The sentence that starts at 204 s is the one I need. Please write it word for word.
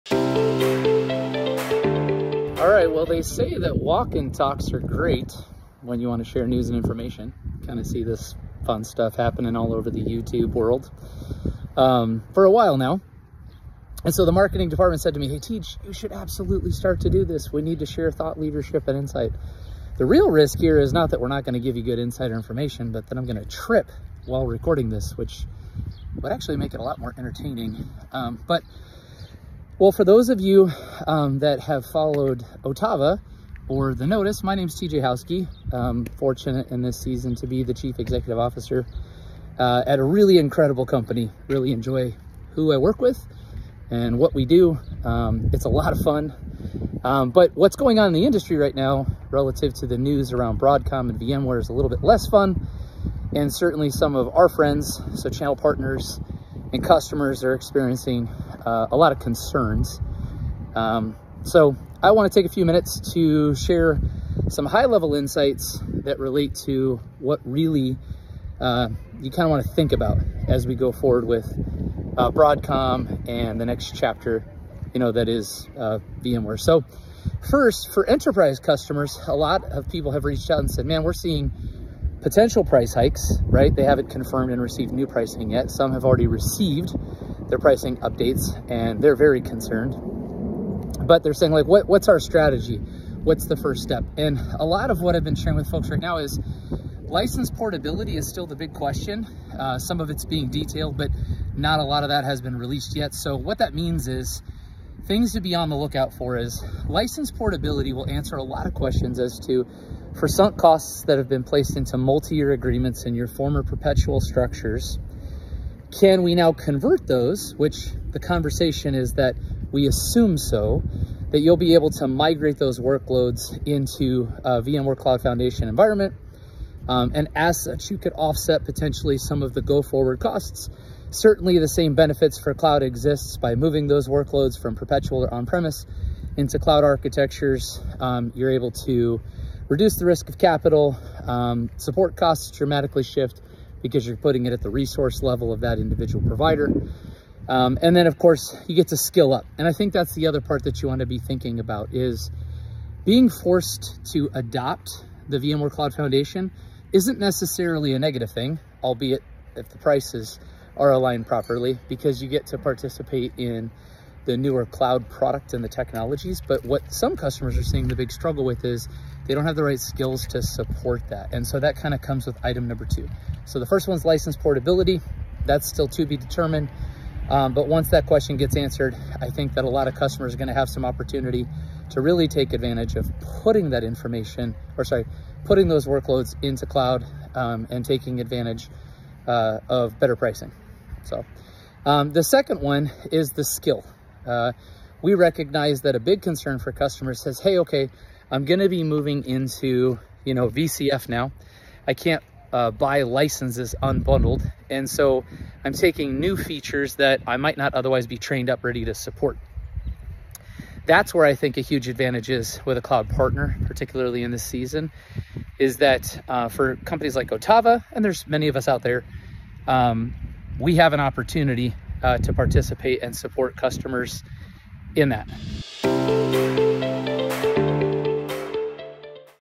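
And so I'm taking new features that I might not otherwise be trained up ready to support.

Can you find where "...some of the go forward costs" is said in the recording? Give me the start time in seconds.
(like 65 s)
129 s.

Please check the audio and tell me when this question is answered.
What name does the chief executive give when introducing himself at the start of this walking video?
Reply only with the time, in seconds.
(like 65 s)
34 s.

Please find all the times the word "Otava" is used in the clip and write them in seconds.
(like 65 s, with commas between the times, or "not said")
32 s, 217 s.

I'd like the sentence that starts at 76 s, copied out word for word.
So first, for enterprise customers, a lot of people have reached out and said, man, we're seeing potential price hikes, right?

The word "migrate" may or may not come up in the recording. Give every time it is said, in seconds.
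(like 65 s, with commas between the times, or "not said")
122 s.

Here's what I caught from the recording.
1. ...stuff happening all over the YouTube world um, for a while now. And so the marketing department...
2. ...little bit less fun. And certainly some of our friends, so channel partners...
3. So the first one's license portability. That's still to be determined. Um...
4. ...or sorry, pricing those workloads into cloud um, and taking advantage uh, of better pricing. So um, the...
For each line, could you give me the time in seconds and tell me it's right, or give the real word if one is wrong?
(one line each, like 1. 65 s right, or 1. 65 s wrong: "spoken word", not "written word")
1. 8 s right
2. 51 s right
3. 173 s right
4. 184 s wrong: "putting", not "pricing".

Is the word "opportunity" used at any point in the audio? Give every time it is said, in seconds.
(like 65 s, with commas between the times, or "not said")
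180 s, 220 s.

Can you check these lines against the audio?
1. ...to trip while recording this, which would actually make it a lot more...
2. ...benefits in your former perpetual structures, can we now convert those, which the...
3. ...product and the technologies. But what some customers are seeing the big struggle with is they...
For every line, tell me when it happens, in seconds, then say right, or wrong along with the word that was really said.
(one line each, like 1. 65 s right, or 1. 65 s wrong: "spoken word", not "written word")
1. 23 s right
2. 112 s wrong: "agreements", not "benefits"
3. 165 s right.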